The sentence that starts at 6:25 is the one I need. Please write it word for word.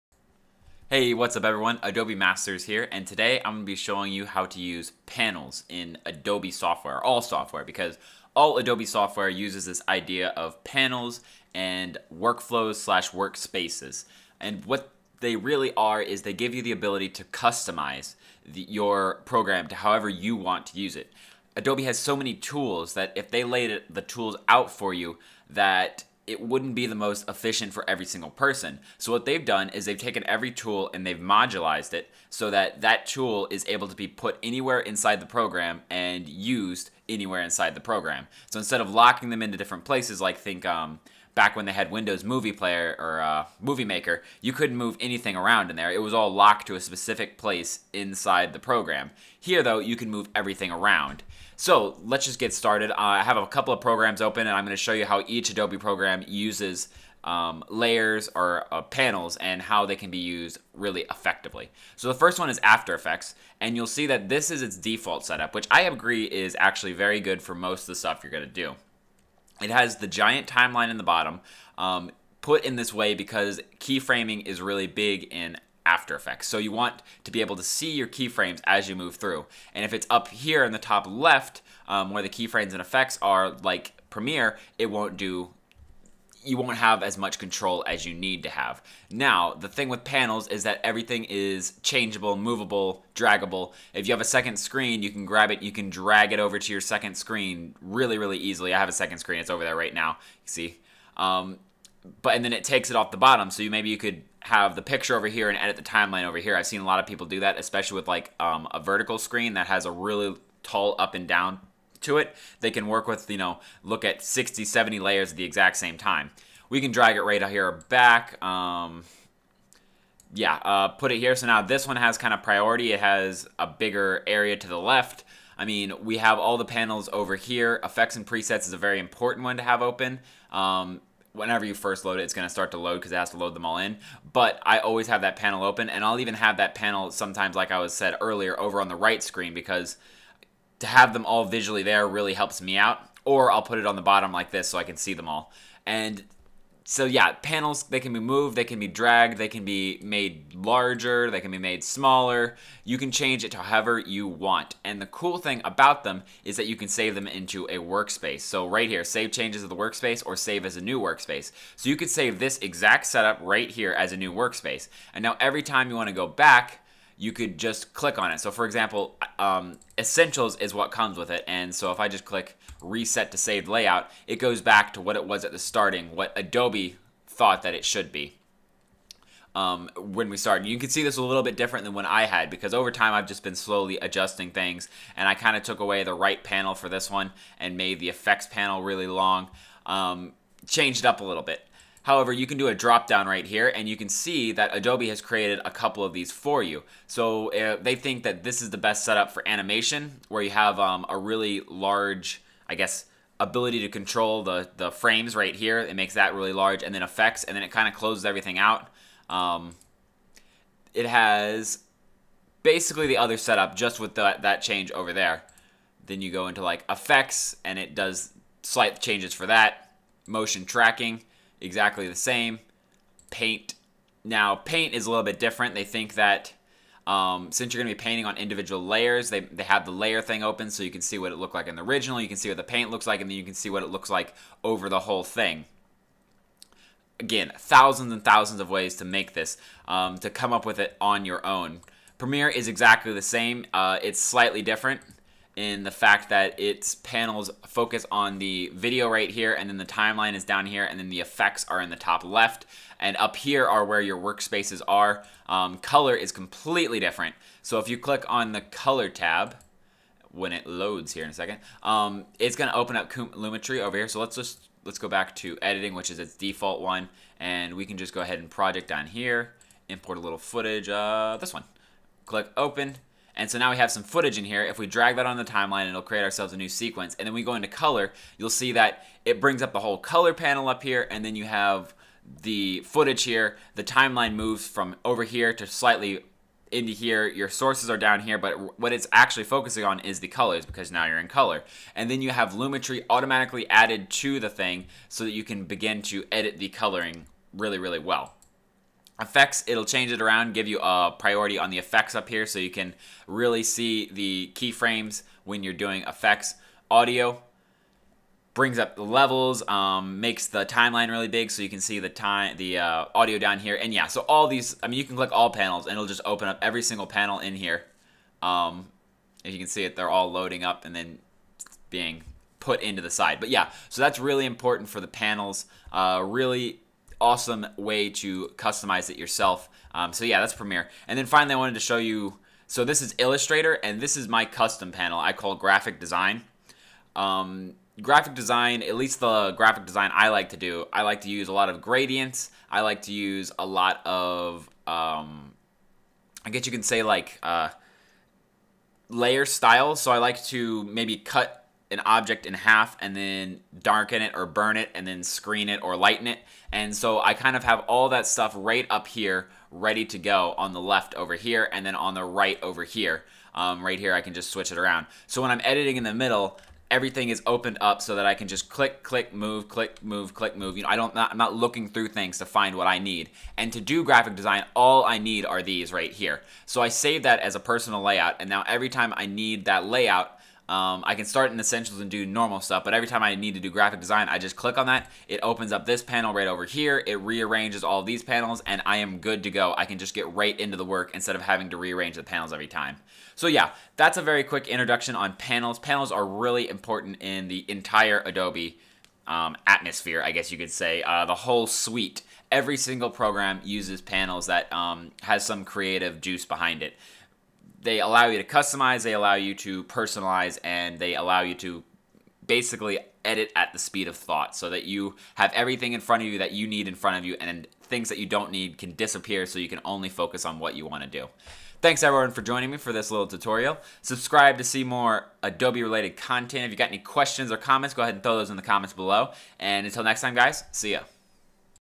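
It opens up this panel right over here.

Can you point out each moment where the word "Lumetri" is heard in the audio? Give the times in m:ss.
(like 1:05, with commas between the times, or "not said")
4:23, 4:52.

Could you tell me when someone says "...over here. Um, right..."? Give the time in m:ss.
6:02.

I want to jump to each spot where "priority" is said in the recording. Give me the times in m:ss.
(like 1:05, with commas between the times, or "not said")
2:02, 5:01.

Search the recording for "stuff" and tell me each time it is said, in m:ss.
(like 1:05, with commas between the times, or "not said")
1:07, 5:58, 6:22.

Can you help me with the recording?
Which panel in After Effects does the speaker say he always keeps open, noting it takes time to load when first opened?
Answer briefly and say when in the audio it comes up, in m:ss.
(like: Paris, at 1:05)
Effects and presets, at 2:07.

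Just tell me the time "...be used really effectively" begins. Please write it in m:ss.
1:00.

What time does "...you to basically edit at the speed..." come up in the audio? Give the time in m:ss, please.
6:51.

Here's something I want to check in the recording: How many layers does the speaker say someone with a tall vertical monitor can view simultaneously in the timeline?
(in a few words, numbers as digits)
60 to 70.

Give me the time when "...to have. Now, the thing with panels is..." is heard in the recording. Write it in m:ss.
1:28.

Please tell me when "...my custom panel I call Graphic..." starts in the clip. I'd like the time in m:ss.
5:34.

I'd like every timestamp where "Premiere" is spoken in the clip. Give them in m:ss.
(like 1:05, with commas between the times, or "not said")
1:24, 4:02, 5:30.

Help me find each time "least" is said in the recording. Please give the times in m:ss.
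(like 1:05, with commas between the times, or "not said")
5:38.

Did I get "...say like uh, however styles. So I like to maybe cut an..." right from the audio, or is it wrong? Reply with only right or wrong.
wrong.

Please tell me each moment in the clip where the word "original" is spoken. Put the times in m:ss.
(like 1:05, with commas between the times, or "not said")
3:51.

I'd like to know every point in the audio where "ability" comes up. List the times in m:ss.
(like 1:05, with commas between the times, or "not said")
0:16, 3:23.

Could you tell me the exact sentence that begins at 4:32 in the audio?
Click open, and so now we have some footage in here.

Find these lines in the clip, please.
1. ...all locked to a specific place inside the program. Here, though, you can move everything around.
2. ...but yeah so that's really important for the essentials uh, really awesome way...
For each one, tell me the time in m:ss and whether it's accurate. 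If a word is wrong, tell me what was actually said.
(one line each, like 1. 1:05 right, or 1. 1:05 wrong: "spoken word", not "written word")
1. 0:46 right
2. 5:23 wrong: "panels", not "essentials".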